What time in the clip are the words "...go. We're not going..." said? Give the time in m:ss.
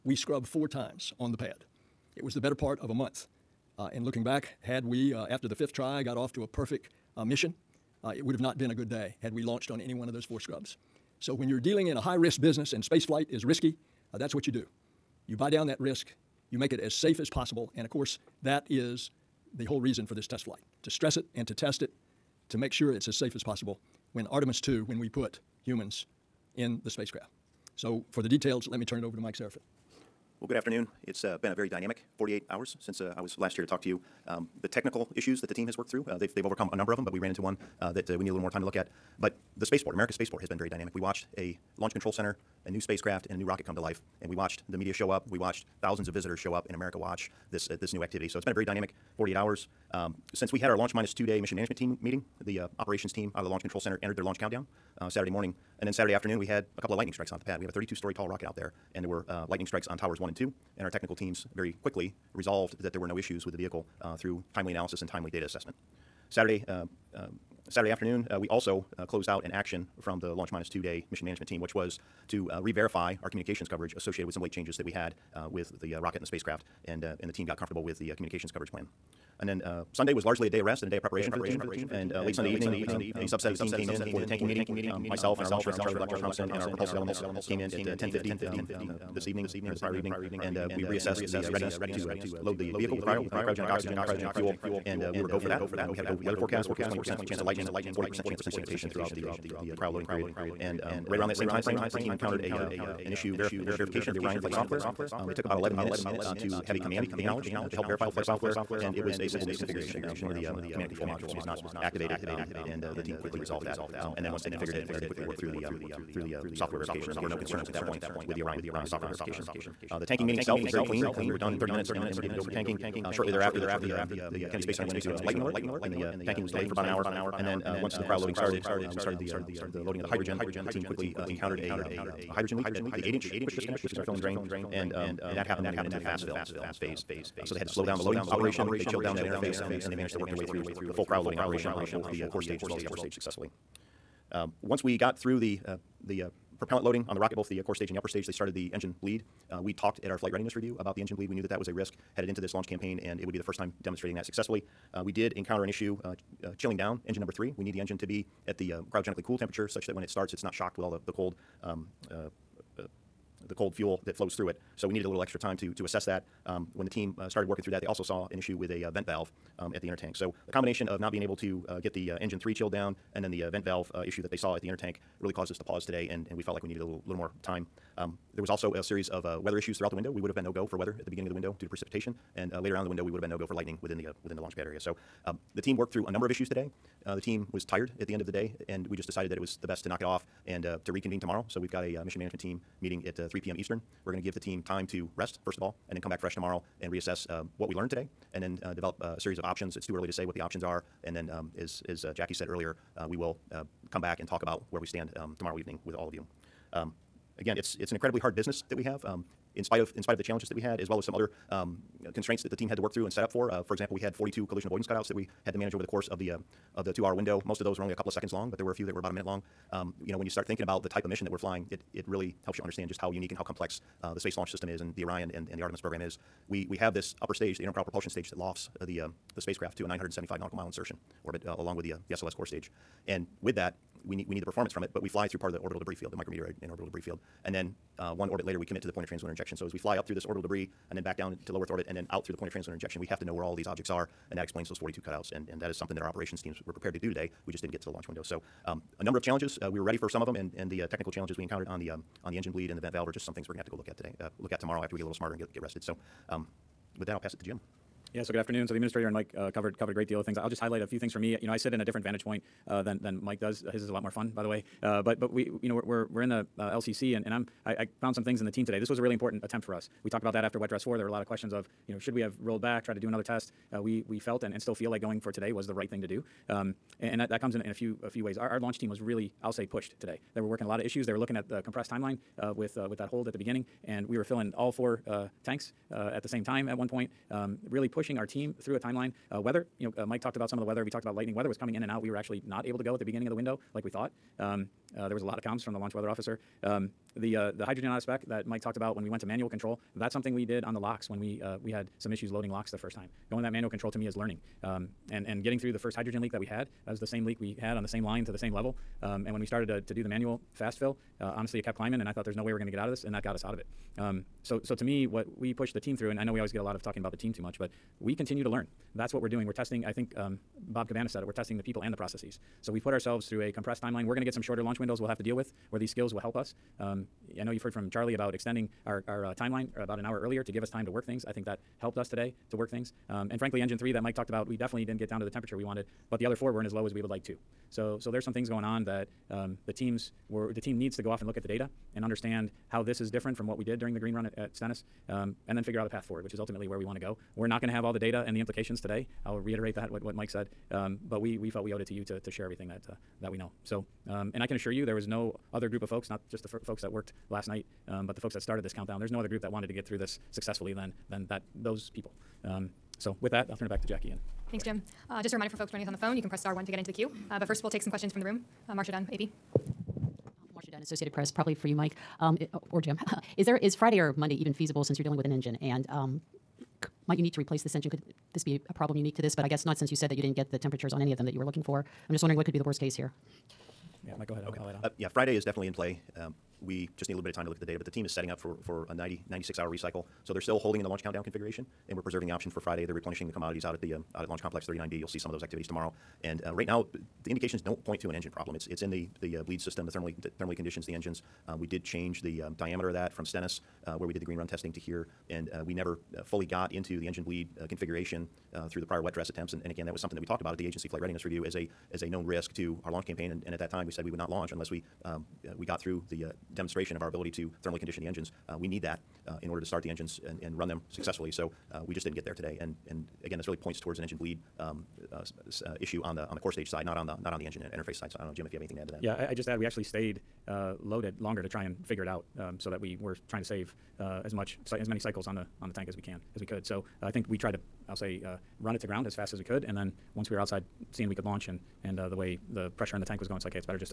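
5:46.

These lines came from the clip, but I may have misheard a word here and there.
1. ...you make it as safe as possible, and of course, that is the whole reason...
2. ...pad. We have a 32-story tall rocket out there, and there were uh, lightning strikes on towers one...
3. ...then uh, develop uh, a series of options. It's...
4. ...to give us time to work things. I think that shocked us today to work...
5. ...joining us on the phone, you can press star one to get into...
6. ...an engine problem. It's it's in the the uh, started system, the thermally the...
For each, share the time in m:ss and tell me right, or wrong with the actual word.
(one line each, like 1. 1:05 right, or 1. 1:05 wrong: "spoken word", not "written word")
1. 0:16 right
2. 0:57 right
3. 3:18 right
4. 5:30 wrong: "helped", not "shocked"
5. 6:05 right
6. 6:38 wrong: "bleed", not "started".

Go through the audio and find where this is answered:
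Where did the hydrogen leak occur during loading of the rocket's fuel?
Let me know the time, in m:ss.
2:13.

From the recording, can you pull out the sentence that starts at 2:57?
Um, there was also a series of uh, weather issues throughout the window.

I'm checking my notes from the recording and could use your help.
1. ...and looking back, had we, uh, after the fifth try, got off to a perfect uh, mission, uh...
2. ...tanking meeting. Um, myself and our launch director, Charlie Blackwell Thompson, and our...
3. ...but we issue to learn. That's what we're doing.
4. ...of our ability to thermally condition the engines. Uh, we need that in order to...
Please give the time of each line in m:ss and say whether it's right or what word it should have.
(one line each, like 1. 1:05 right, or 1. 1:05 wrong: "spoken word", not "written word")
1. 0:03 right
2. 1:24 right
3. 5:17 wrong: "continue", not "issue"
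4. 6:56 right.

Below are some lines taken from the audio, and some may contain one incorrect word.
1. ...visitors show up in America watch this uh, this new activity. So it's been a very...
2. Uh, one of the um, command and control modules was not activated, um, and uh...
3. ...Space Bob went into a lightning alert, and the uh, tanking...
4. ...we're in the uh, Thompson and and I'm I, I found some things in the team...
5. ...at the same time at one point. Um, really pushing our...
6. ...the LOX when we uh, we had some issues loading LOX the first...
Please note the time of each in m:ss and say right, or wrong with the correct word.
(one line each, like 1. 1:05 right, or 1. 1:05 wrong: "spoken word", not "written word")
1. 0:46 right
2. 1:50 right
3. 2:04 wrong: "Center", not "Bob"
4. 4:26 wrong: "LCC", not "Thompson"
5. 4:46 right
6. 5:00 right.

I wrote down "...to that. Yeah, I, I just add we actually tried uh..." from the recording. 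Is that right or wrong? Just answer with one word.
wrong.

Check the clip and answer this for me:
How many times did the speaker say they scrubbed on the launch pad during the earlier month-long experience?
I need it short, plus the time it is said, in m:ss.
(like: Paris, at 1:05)
4, at 0:00.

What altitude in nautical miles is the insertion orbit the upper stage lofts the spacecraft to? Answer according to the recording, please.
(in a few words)
975 nautical miles.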